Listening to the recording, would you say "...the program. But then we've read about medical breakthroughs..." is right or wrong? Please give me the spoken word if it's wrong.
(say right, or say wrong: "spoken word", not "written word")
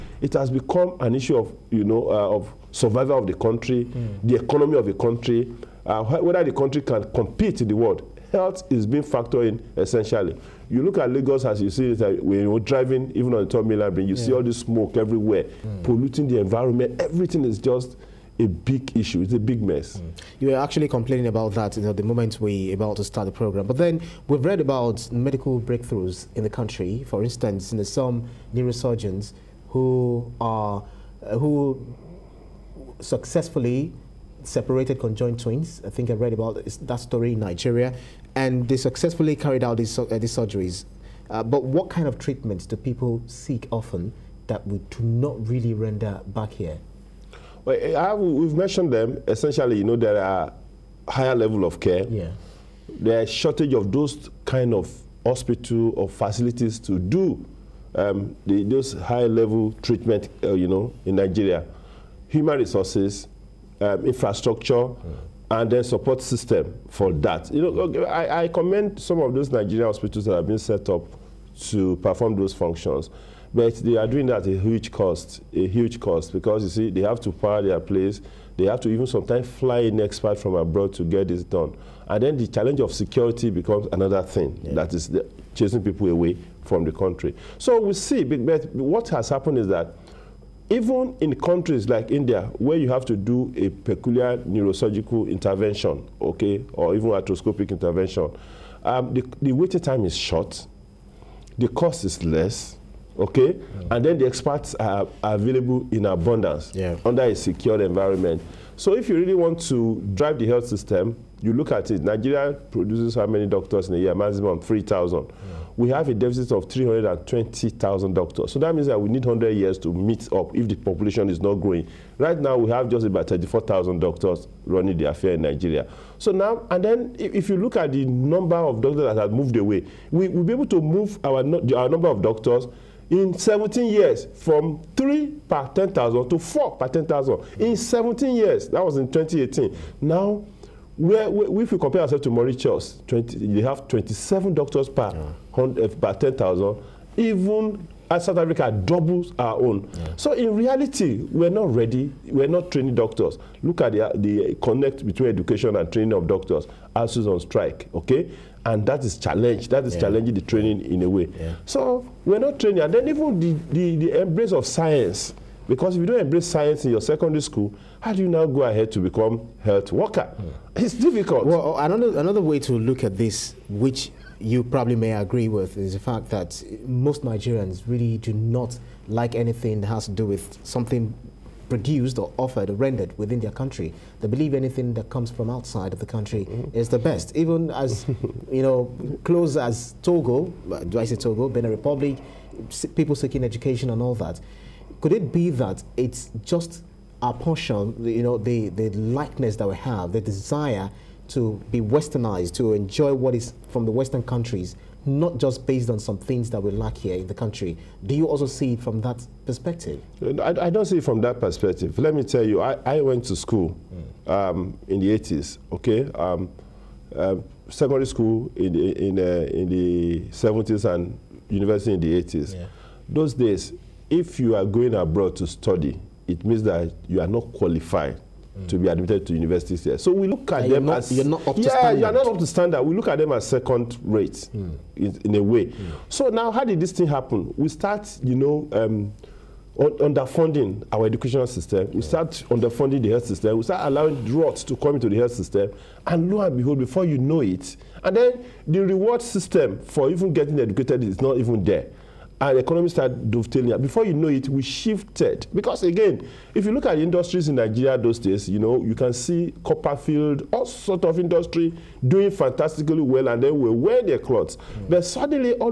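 right.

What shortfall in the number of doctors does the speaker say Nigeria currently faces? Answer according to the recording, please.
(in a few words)
320,000.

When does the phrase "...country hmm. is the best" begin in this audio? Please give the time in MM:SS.
03:06.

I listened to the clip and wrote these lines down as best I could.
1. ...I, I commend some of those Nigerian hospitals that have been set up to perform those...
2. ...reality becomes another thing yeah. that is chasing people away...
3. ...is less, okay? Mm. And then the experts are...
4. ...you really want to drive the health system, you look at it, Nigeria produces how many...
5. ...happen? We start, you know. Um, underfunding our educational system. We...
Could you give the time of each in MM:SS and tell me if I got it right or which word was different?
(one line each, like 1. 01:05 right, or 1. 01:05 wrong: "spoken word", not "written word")
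1. 01:08 right
2. 01:22 wrong: "security", not "reality"
3. 01:42 right
4. 01:49 right
5. 03:57 right.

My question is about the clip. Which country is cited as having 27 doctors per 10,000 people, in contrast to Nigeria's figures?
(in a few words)
Mauritius.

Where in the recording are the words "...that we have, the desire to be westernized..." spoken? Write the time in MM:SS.
03:19.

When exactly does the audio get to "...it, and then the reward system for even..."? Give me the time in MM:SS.
04:07.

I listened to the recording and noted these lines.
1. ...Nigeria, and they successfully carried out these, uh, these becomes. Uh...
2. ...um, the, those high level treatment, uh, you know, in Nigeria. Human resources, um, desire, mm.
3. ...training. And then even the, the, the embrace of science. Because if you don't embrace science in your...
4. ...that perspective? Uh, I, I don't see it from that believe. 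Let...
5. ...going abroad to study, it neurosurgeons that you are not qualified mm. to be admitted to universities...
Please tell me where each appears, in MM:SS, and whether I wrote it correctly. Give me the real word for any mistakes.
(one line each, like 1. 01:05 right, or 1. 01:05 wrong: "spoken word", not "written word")
1. 00:37 wrong: "surgeries", not "becomes"
2. 00:57 wrong: "infrastructure", not "desire"
3. 02:42 right
4. 03:29 wrong: "perspective", not "believe"
5. 03:44 wrong: "means", not "neurosurgeons".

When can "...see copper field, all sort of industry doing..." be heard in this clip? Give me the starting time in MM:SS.
04:19.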